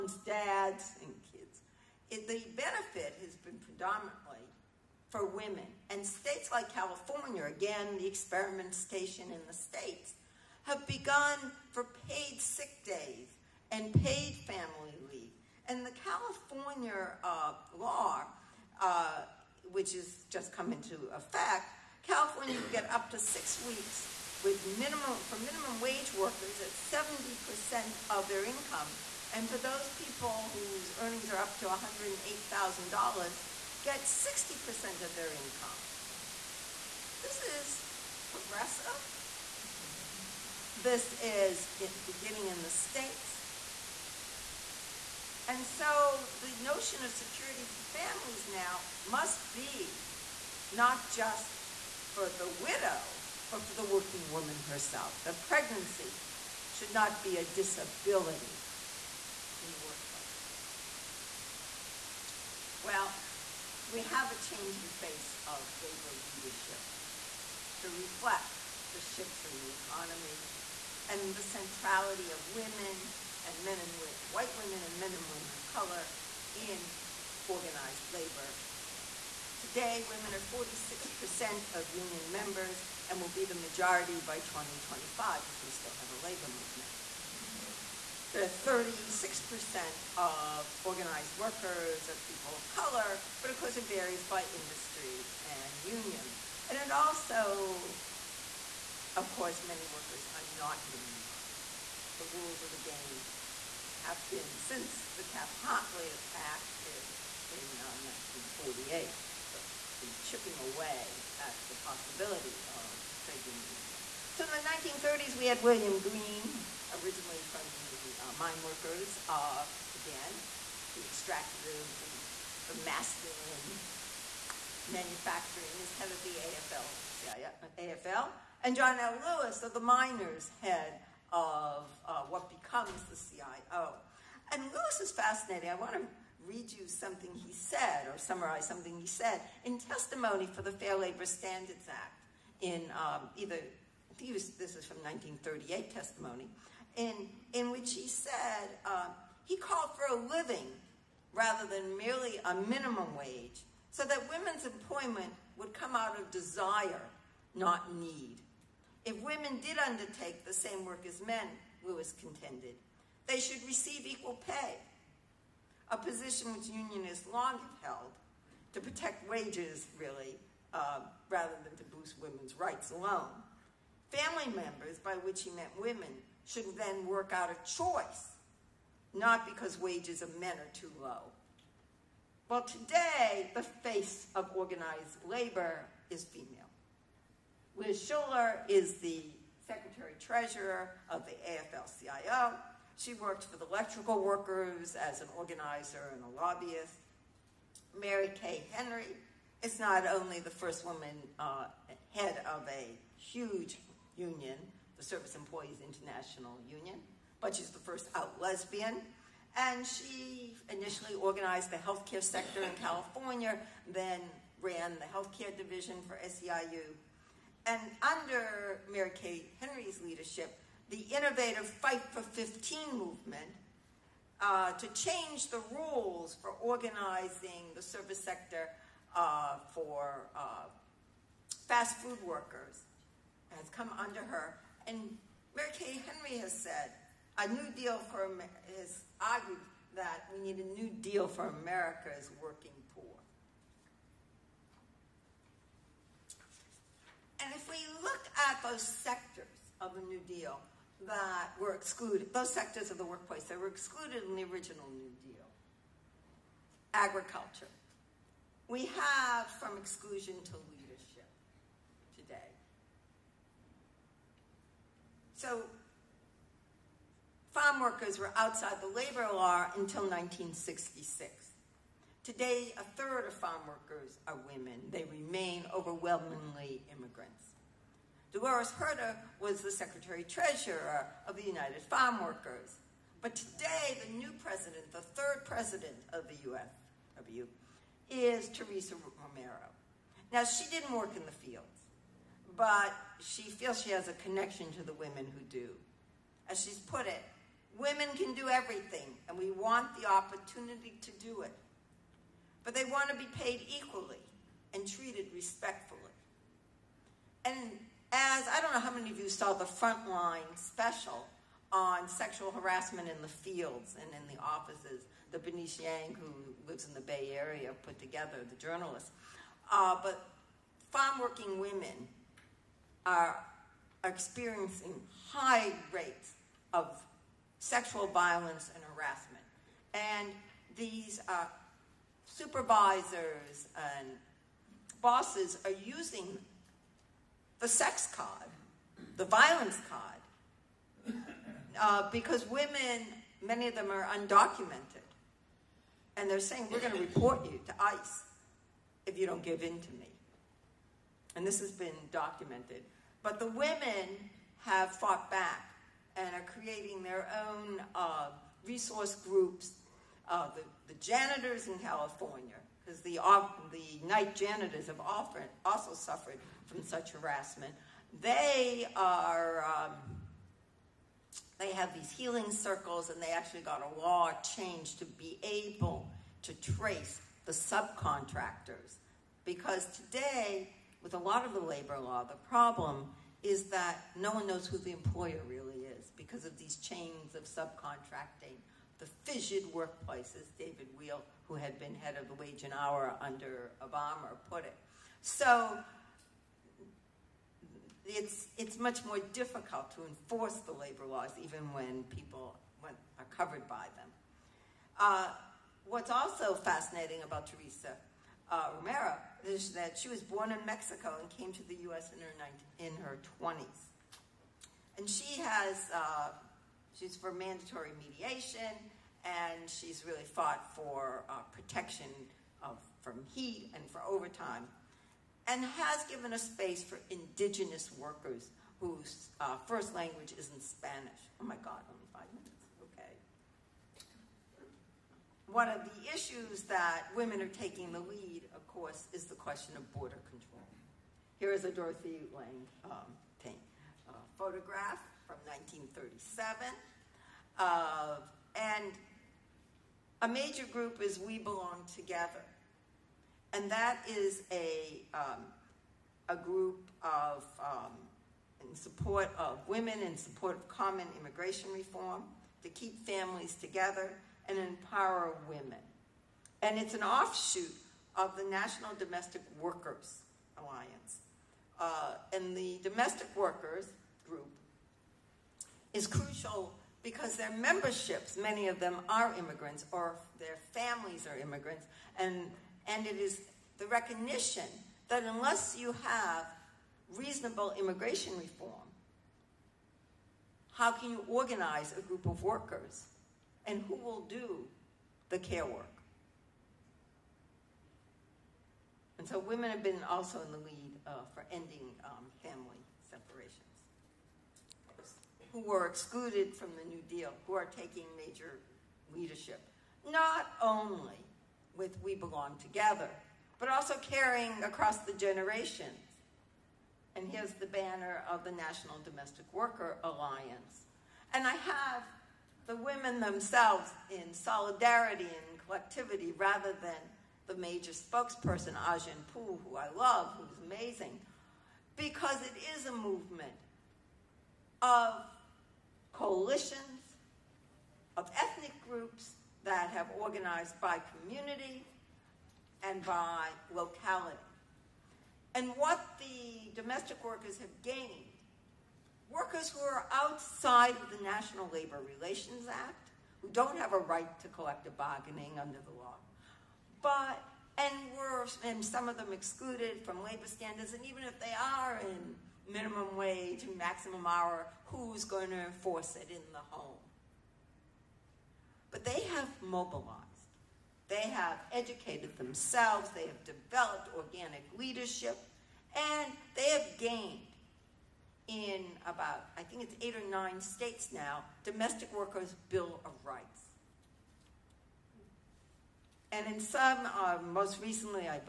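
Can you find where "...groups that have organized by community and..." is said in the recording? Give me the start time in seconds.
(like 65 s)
538 s.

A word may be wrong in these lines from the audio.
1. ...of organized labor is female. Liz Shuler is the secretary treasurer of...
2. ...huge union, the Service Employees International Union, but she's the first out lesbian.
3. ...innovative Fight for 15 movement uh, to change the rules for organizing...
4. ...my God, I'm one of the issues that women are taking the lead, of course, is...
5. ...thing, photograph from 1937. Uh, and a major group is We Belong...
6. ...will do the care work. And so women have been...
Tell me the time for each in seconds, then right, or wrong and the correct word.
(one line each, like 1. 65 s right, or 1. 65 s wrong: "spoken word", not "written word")
1. 184 s right
2. 203 s right
3. 221 s right
4. 431 s right
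5. 443 s right
6. 493 s right.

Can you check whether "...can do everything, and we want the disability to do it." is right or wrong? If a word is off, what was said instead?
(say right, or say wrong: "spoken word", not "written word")
wrong: "opportunity", not "disability".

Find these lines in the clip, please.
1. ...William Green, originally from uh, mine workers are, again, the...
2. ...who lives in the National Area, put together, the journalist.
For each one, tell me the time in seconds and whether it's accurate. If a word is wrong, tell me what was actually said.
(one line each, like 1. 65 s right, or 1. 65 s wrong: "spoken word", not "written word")
1. 115 s right
2. 316 s wrong: "Bay", not "National".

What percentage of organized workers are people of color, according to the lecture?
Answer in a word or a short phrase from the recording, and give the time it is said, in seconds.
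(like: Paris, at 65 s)
36%, at 88 s.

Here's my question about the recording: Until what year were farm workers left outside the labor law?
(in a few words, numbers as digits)
1966.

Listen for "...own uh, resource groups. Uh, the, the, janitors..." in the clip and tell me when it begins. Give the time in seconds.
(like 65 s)
357 s.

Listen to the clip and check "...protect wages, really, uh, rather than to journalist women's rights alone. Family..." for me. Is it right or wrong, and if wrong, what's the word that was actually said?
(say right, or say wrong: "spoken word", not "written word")
wrong: "boost", not "journalist".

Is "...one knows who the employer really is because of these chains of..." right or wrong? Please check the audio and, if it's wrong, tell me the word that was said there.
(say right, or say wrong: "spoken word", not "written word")
right.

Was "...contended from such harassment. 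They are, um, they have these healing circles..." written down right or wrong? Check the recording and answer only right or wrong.
wrong.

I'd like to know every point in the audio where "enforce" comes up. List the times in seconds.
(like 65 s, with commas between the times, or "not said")
400 s, 565 s.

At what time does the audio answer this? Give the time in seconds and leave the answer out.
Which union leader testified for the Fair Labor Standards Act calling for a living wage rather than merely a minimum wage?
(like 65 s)
128 s.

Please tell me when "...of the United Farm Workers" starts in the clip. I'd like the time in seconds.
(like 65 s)
281 s.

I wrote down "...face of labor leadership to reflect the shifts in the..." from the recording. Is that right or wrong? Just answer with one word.
right.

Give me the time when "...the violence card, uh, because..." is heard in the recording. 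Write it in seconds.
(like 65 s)
339 s.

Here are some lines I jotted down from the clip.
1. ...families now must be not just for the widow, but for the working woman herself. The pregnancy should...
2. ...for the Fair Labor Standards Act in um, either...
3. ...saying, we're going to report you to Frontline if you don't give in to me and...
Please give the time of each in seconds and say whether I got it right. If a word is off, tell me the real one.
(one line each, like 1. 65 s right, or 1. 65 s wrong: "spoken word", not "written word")
1. 47 s right
2. 140 s right
3. 346 s wrong: "ICE", not "Frontline".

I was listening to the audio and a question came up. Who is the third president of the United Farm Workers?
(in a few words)
Teresa Romero.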